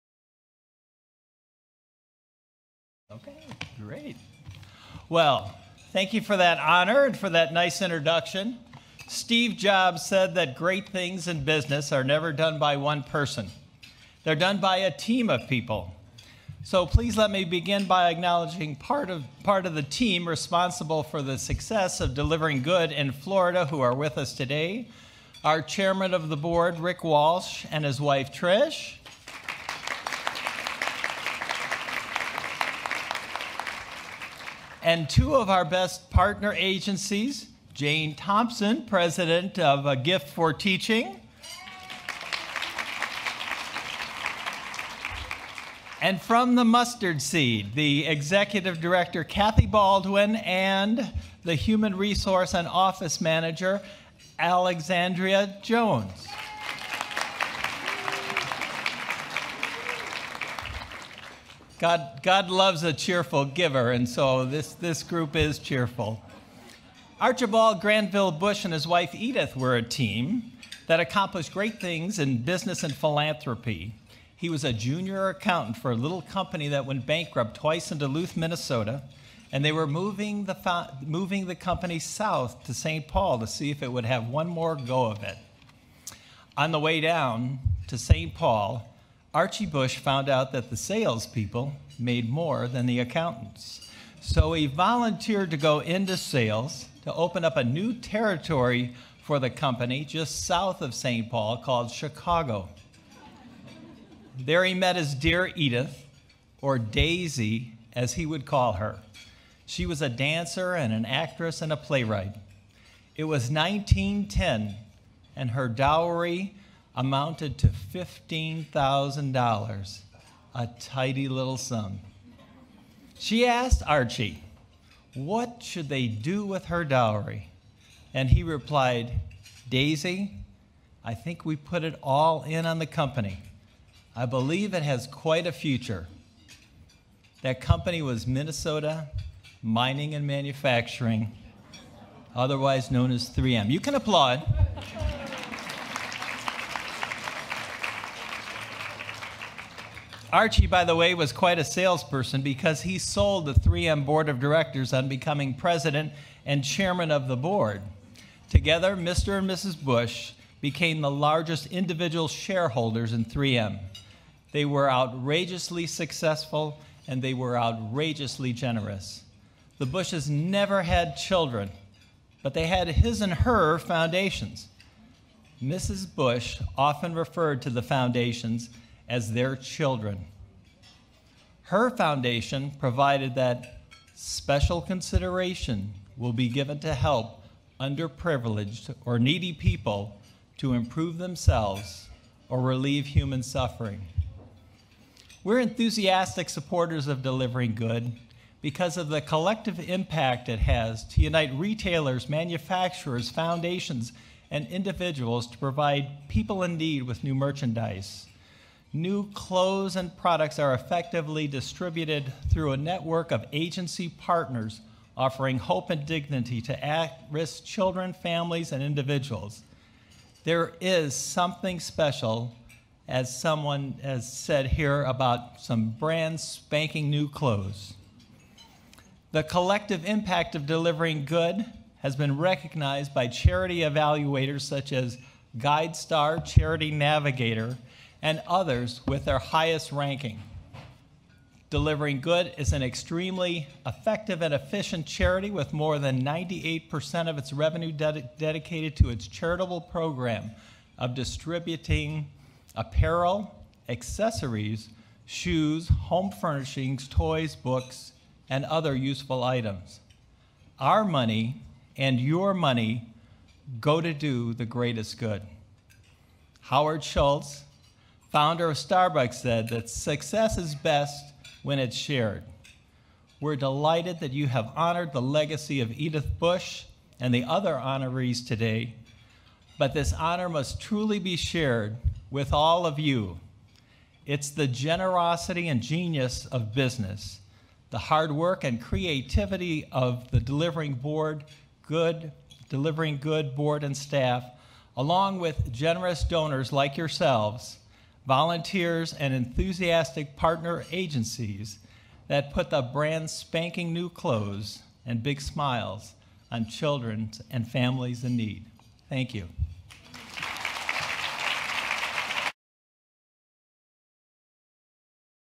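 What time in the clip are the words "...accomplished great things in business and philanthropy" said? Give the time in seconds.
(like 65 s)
70 s.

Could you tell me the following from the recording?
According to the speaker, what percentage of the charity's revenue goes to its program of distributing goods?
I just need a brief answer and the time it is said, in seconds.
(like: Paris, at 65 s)
98%, at 246 s.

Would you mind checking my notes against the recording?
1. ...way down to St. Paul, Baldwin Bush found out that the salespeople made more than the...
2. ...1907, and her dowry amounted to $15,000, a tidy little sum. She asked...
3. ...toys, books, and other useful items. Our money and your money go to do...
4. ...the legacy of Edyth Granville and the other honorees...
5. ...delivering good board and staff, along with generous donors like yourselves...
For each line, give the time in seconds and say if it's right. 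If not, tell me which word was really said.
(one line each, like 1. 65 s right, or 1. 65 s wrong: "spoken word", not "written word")
1. 86 s wrong: "Archie", not "Baldwin"
2. 113 s wrong: "1910", not "1907"
3. 257 s right
4. 275 s wrong: "Bush", not "Granville"
5. 292 s right.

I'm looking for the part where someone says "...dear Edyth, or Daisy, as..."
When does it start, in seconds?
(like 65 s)
105 s.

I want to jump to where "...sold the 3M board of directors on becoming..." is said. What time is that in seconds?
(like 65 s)
152 s.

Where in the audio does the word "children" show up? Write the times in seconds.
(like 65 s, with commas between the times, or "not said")
171 s, 179 s, 217 s, 306 s.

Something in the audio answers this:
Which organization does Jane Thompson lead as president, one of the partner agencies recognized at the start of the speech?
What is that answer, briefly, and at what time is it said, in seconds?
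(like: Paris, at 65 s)
A Gift for Teaching, at 39 s.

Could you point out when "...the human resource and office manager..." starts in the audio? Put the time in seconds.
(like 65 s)
51 s.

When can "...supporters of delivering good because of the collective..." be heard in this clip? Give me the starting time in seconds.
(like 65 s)
196 s.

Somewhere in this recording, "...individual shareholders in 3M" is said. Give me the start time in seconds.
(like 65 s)
161 s.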